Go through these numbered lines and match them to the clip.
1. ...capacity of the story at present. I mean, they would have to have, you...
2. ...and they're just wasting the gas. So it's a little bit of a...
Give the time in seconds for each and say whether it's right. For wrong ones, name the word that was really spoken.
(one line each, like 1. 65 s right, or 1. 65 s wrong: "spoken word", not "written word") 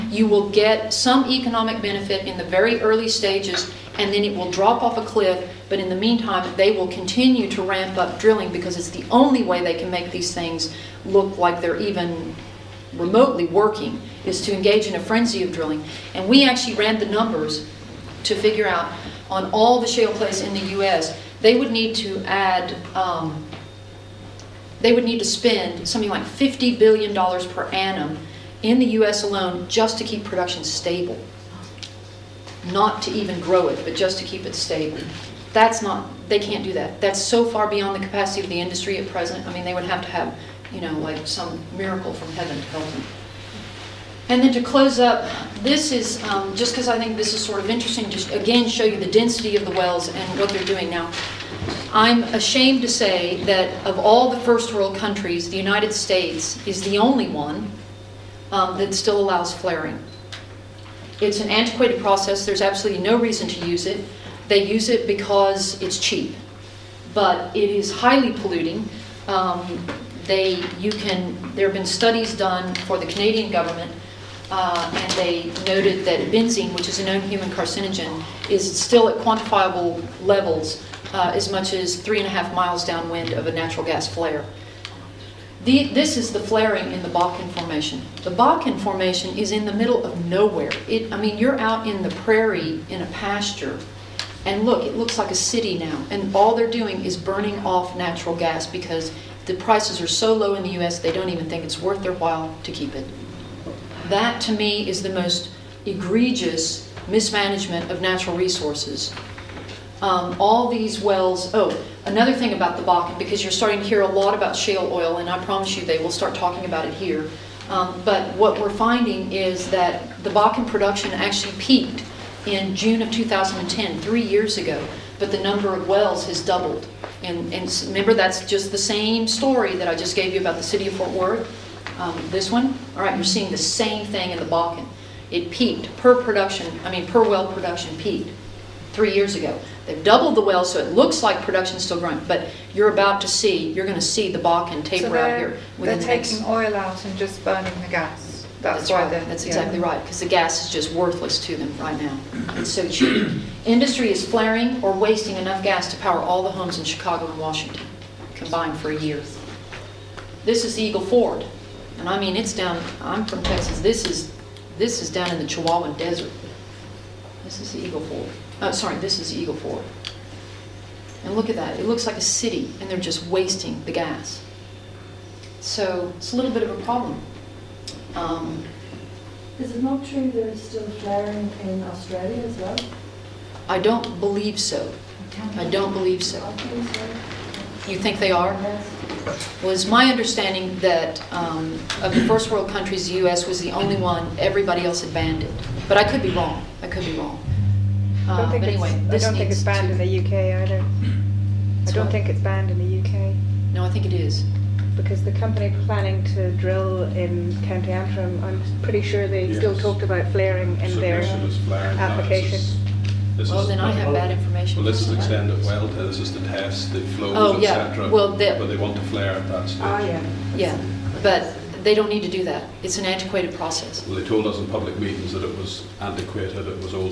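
1. 38 s wrong: "industry", not "story"
2. 172 s right.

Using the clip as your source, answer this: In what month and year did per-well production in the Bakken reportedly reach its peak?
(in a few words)
June 2010.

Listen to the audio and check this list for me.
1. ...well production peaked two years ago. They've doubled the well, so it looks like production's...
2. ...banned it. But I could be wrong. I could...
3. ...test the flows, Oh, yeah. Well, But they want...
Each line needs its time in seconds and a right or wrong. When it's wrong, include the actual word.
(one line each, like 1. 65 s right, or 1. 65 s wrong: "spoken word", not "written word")
1. 137 s wrong: "three", not "two"
2. 195 s right
3. 216 s right.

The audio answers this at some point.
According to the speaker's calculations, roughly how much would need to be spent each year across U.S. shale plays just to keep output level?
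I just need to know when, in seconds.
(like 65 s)
26 s.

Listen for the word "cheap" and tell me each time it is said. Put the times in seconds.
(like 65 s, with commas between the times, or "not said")
65 s, 152 s.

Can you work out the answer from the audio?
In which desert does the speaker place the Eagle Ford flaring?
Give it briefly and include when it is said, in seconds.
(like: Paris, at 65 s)
Chihuahuan Desert, at 165 s.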